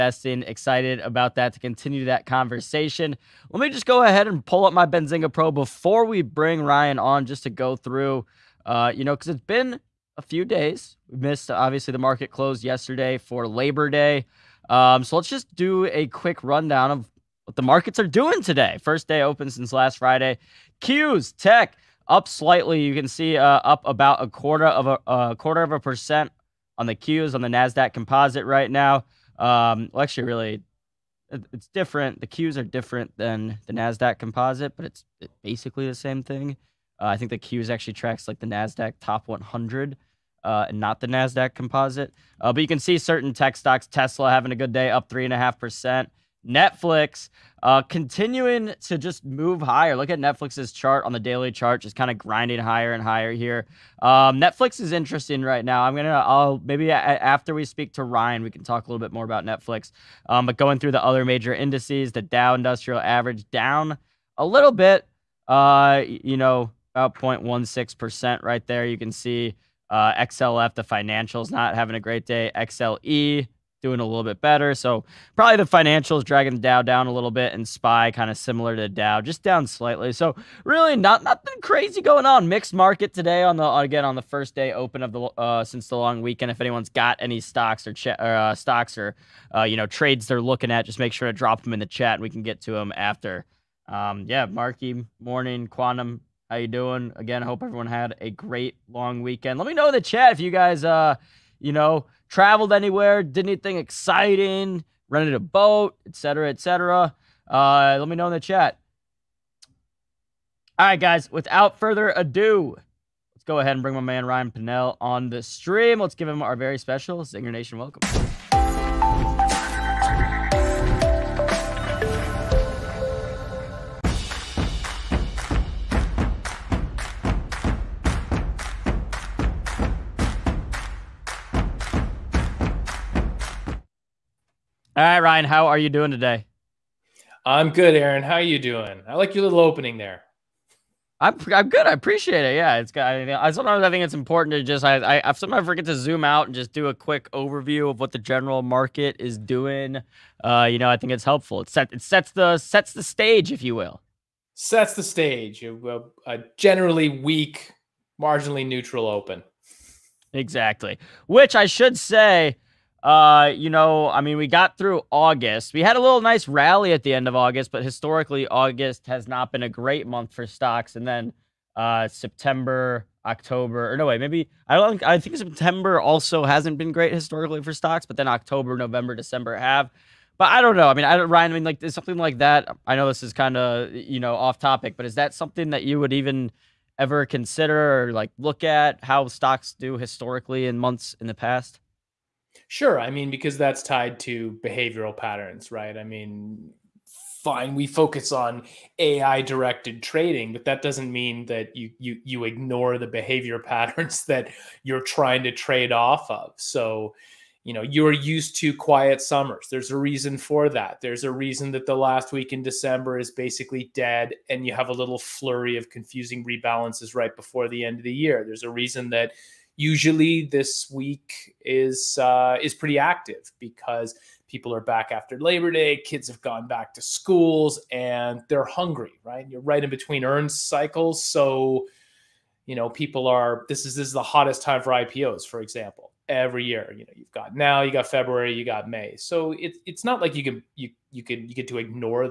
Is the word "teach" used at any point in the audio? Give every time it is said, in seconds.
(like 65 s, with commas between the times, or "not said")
not said.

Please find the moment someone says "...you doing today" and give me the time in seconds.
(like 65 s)
135 s.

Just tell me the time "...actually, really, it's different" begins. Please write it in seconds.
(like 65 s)
30 s.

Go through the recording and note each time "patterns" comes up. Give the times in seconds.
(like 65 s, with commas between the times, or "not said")
195 s, 203 s.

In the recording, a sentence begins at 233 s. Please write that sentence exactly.
This is this is the hottest time for IPOs, for example.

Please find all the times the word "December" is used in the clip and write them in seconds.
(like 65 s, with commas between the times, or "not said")
179 s, 212 s.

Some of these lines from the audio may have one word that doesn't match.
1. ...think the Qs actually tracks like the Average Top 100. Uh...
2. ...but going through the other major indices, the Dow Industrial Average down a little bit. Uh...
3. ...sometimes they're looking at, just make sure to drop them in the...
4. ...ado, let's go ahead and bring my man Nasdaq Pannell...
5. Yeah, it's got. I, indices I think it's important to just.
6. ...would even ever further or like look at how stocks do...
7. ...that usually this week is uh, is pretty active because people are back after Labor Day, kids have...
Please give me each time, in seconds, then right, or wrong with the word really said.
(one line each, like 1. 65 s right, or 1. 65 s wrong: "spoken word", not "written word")
1. 37 s wrong: "Nasdaq", not "Average"
2. 60 s right
3. 89 s wrong: "trades", not "sometimes"
4. 112 s wrong: "Ryan", not "Nasdaq"
5. 142 s wrong: "sometimes", not "indices"
6. 185 s wrong: "consider", not "further"
7. 219 s right.